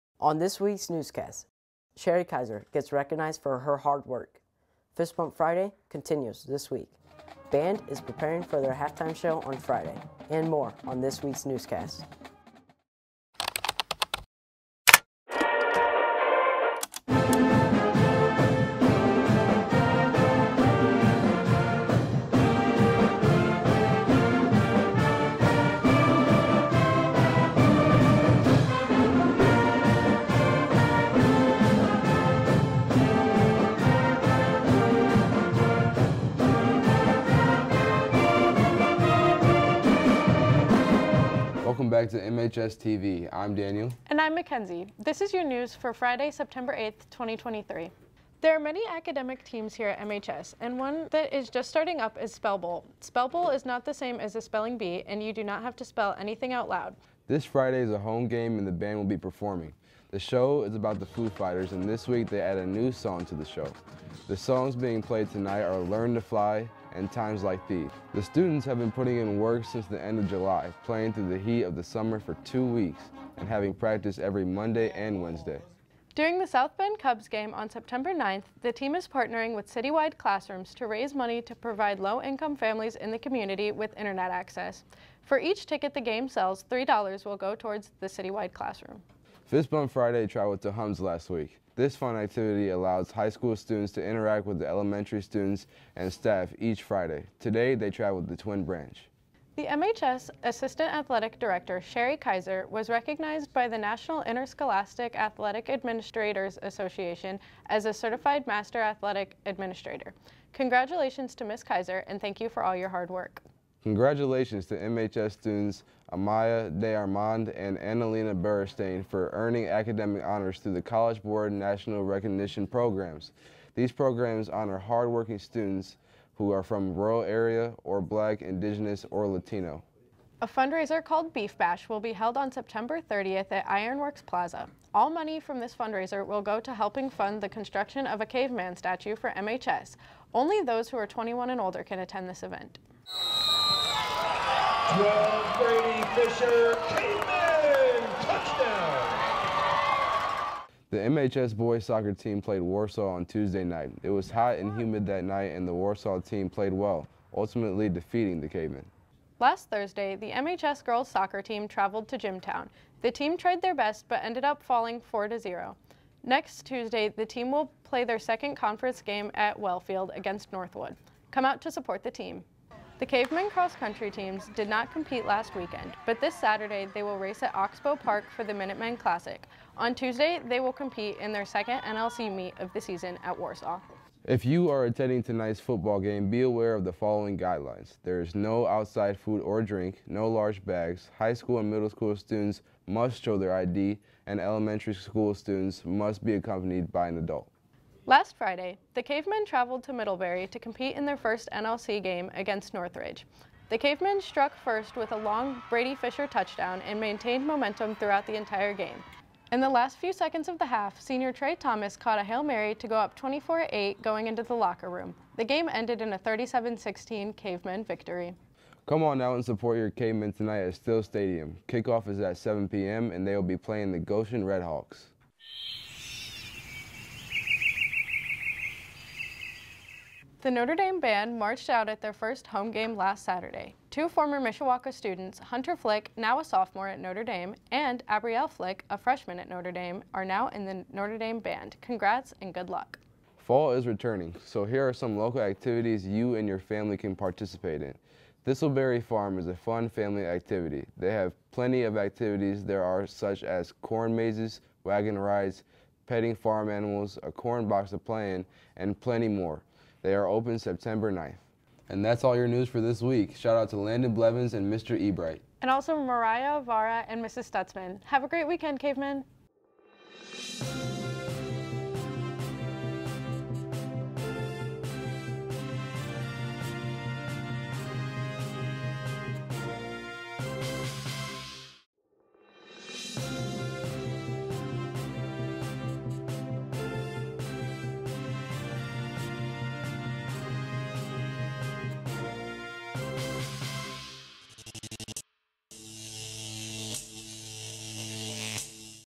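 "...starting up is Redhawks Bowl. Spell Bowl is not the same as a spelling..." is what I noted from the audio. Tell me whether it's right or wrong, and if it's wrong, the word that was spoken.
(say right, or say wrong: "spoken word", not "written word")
wrong: "Spell", not "Redhawks".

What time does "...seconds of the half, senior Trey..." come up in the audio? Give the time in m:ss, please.
3:30.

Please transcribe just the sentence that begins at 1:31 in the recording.
This fun activity allows high school students to interact with the elementary students and staff each Friday.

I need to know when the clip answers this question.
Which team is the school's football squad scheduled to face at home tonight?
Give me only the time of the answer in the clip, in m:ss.
3:43.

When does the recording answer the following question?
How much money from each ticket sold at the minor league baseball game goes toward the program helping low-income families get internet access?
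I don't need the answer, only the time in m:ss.
1:26.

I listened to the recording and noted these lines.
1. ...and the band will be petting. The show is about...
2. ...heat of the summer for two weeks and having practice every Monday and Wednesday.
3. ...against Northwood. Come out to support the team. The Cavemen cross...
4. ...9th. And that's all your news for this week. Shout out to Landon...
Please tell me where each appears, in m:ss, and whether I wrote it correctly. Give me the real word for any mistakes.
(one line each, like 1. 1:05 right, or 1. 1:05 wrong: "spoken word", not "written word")
1. 0:58 wrong: "performing", not "petting"
2. 1:11 right
3. 2:50 right
4. 4:21 right.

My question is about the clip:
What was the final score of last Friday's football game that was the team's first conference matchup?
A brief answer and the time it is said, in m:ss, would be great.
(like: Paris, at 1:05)
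37-16, at 3:36.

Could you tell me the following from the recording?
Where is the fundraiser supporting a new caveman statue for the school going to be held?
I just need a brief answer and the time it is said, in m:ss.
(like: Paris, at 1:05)
Ironworks Plaza, at 2:13.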